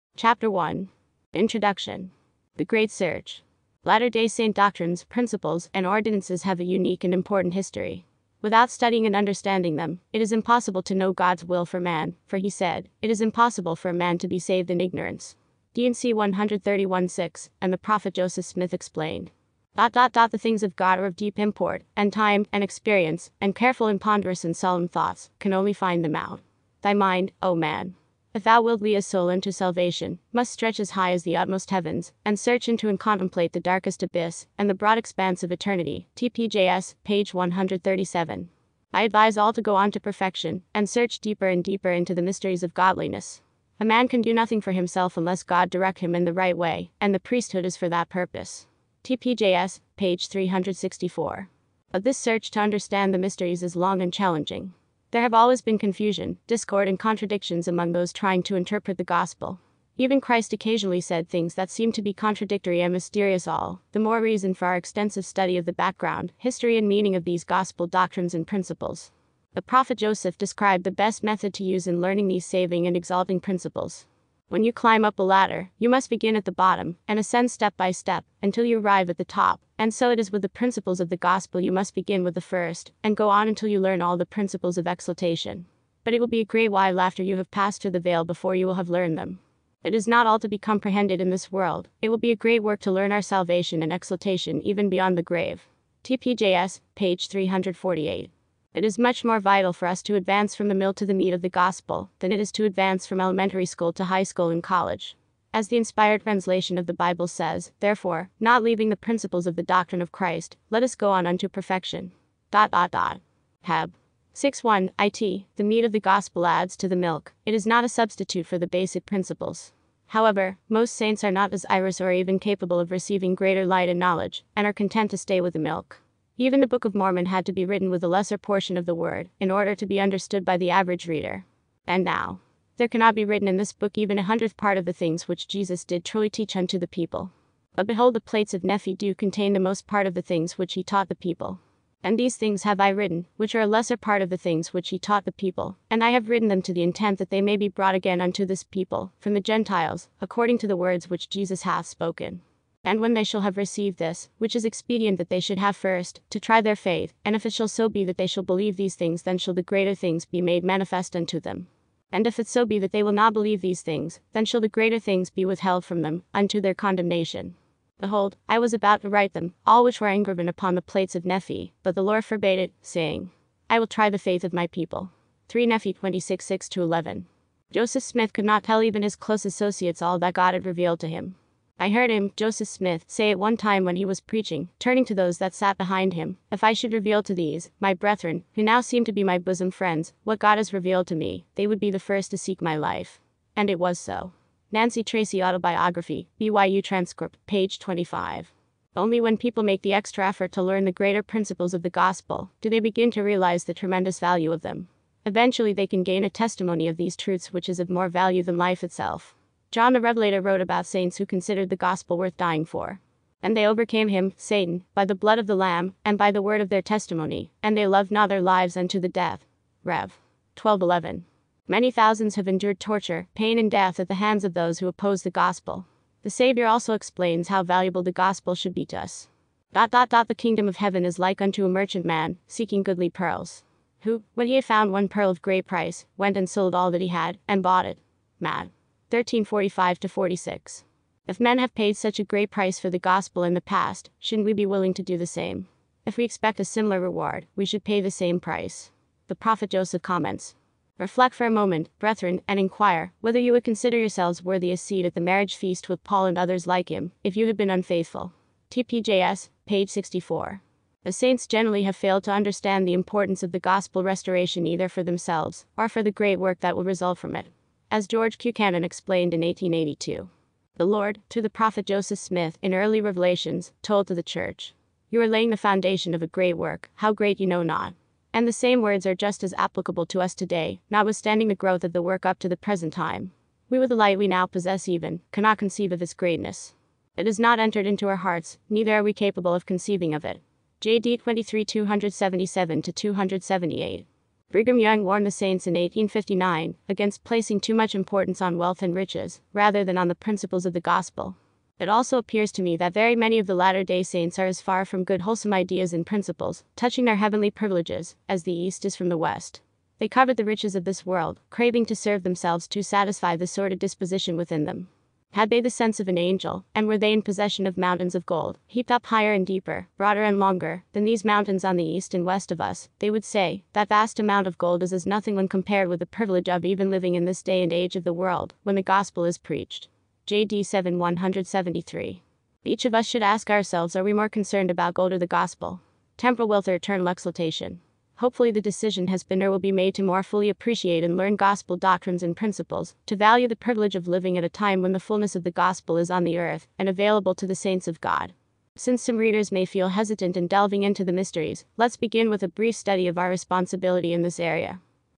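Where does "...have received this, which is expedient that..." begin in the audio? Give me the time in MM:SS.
02:33.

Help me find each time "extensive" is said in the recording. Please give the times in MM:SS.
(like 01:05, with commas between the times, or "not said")
01:04.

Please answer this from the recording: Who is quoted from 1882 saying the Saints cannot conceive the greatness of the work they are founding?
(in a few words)
George Buchanan.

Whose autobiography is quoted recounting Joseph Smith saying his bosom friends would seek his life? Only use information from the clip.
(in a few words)
Nancy Tracy.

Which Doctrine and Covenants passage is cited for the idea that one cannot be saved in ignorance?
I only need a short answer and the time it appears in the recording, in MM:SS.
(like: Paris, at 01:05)
D&C 131:6, at 00:15.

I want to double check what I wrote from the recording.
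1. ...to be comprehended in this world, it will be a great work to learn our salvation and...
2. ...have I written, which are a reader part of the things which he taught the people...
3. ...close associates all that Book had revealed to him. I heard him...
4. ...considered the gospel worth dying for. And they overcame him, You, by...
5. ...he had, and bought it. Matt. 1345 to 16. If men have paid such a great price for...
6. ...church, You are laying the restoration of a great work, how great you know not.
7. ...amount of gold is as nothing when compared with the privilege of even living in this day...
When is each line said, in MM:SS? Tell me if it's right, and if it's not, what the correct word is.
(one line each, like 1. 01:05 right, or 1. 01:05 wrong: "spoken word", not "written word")
1. 01:30 right
2. 02:22 wrong: "lesser", not "reader"
3. 02:59 wrong: "God", not "Book"
4. 03:31 wrong: "Satan", not "You"
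5. 03:56 wrong: "46", not "16"
6. 04:34 wrong: "foundation", not "restoration"
7. 05:24 right.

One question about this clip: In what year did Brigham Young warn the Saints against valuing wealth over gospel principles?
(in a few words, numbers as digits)
1859.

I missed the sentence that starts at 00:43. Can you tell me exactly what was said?
A man can do nothing for himself unless God direct him in the right way, and the priesthood is for that purpose.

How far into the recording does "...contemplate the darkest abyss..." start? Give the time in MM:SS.
00:32.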